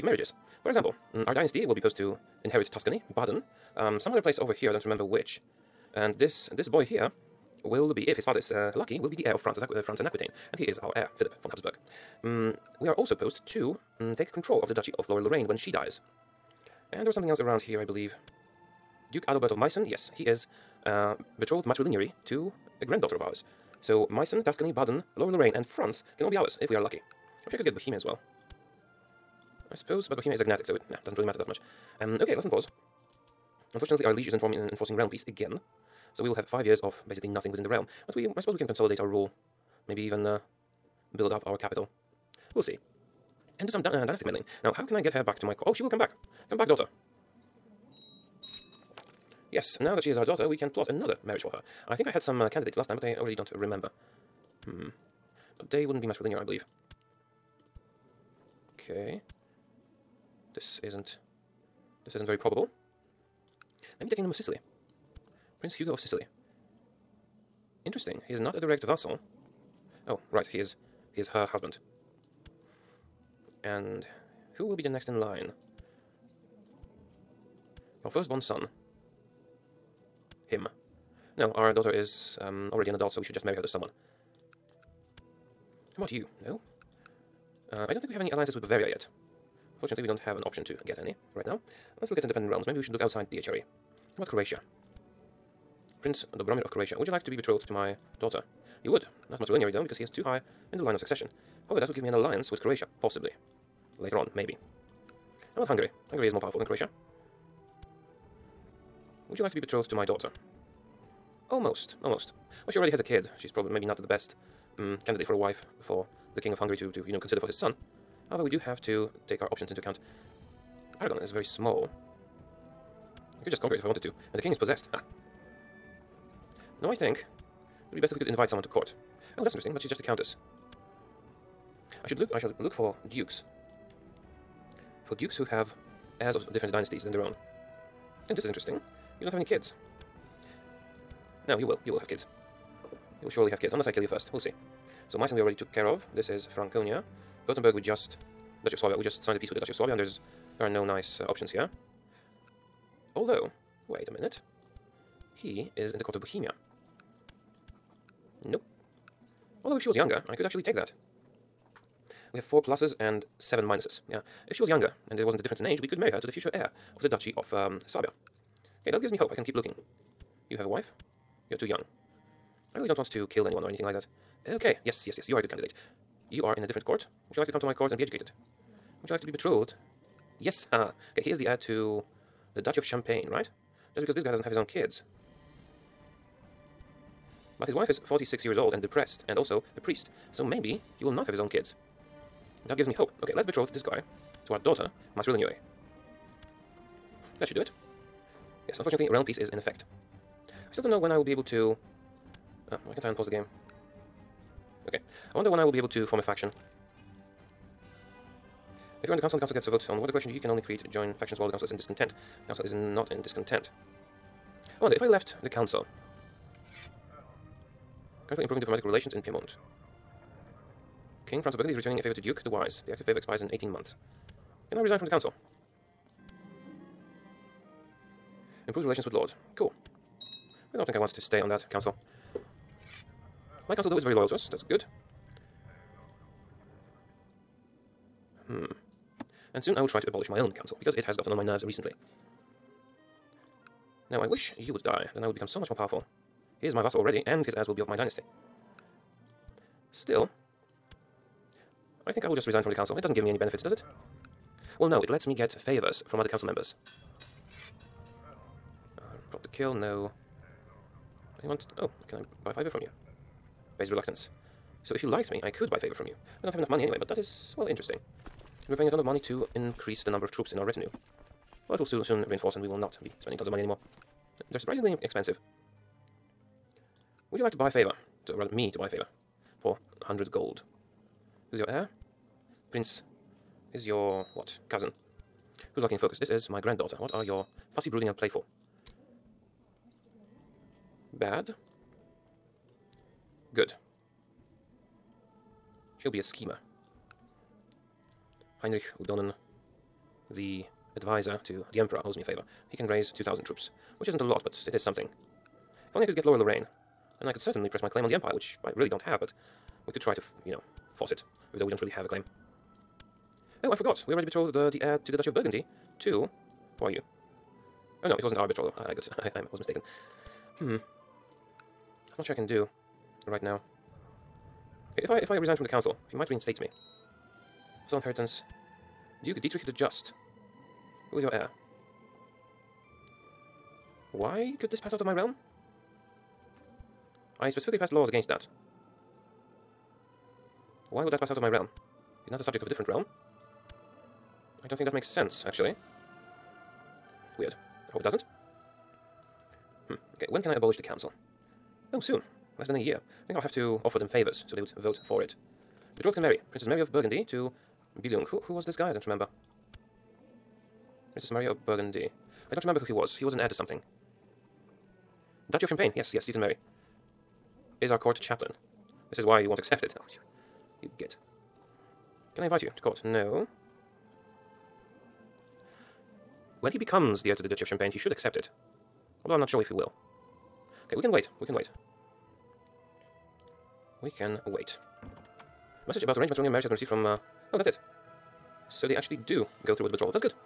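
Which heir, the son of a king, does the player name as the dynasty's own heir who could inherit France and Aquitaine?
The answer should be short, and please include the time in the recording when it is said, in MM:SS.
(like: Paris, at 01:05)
Philip von Habsburg, at 00:11.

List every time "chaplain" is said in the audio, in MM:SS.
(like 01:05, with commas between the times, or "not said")
06:08.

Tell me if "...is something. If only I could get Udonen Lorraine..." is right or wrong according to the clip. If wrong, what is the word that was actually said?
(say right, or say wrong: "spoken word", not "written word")
wrong: "Lower", not "Udonen".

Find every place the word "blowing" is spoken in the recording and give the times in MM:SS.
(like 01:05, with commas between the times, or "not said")
not said.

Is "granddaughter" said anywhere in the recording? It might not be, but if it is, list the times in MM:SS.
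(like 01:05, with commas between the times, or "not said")
00:22, 04:46.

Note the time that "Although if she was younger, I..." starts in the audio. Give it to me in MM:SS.
02:39.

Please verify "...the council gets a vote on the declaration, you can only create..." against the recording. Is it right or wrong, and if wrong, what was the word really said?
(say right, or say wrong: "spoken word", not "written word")
right.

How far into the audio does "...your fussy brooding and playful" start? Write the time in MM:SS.
04:47.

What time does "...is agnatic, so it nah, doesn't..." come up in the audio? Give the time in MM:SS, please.
00:30.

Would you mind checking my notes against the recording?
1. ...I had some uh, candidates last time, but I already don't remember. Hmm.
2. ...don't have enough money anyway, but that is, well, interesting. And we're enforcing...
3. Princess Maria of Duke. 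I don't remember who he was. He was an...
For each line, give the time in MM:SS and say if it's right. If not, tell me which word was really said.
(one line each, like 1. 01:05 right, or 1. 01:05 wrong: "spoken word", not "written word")
1. 00:52 right
2. 04:26 wrong: "paying", not "enforcing"
3. 06:01 wrong: "Burgundy", not "Duke".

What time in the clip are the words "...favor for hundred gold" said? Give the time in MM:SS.
04:38.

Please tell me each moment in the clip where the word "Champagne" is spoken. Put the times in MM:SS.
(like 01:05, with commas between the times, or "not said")
03:02, 06:05, 06:17.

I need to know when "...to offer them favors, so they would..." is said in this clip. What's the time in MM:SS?
05:53.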